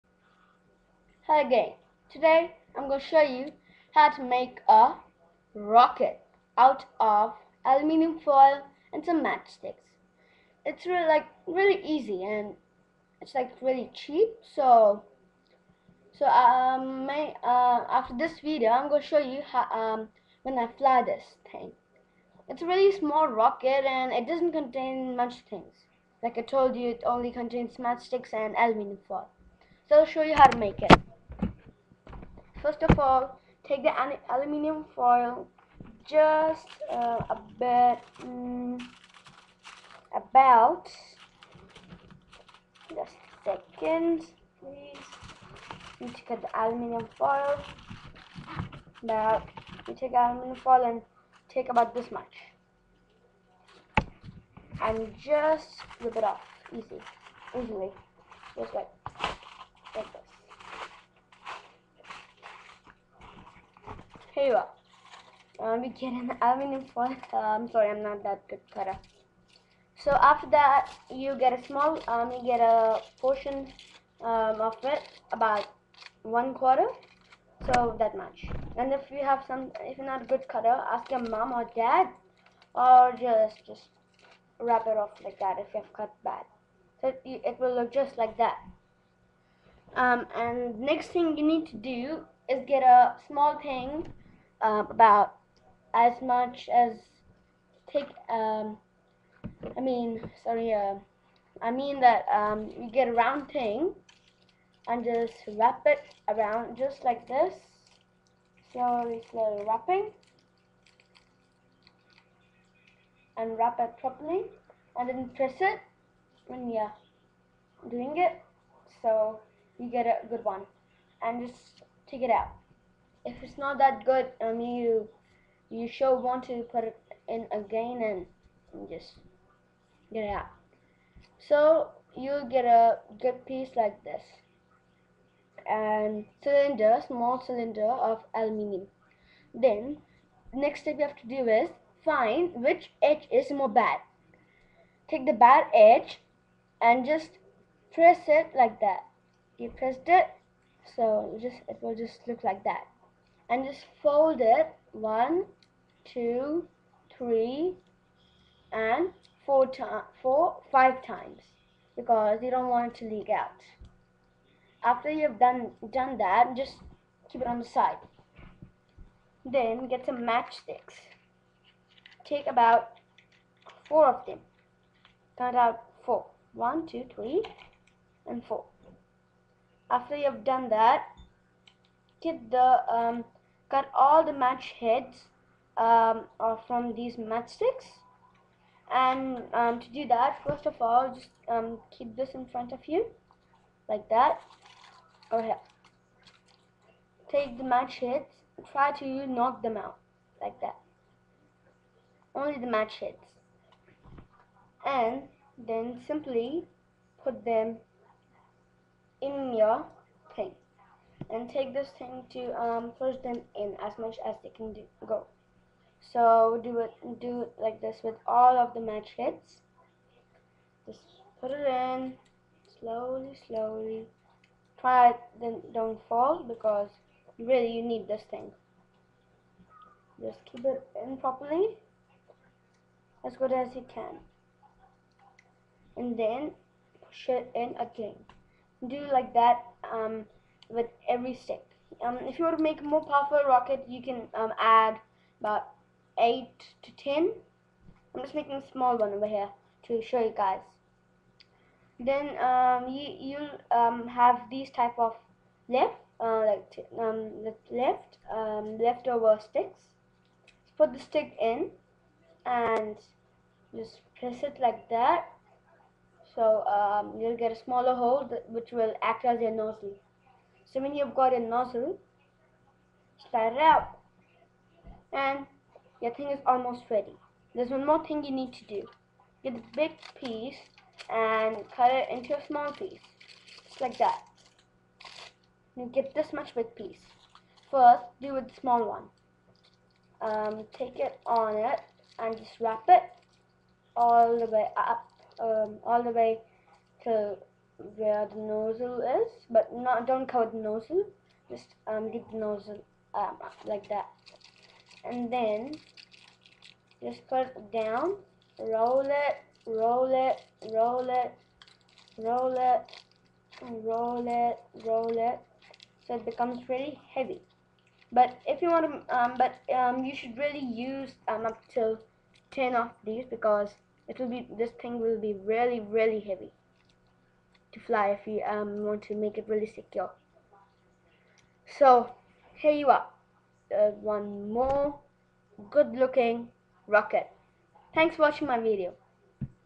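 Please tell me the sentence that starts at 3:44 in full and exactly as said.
Try it, then don't fall because really you need this thing.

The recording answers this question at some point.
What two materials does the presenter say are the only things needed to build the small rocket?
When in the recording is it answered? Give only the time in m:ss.
0:27.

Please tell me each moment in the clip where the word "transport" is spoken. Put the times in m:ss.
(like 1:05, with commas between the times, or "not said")
not said.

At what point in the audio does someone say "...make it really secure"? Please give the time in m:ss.
5:29.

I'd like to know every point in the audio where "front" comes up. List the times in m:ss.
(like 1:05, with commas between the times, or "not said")
3:12.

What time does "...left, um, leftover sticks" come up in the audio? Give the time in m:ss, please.
4:17.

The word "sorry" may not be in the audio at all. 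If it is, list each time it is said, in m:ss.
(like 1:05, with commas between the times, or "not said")
1:07, 1:40.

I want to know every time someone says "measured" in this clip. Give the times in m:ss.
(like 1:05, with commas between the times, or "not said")
not said.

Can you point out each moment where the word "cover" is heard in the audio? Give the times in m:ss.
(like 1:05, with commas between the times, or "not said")
5:00.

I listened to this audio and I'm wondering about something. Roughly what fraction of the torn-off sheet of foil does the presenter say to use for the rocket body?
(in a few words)
One quarter.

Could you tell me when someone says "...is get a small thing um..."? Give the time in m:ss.
1:32.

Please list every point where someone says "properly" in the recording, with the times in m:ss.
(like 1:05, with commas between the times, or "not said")
1:53, 3:51.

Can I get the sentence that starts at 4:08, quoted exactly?
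I'm just making a small one over here to show you guys.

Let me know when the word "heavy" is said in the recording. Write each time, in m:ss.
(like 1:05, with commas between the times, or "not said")
5:17, 5:26.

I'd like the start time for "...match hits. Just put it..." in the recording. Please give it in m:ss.
3:38.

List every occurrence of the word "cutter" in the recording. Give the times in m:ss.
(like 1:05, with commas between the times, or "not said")
1:08, 1:20.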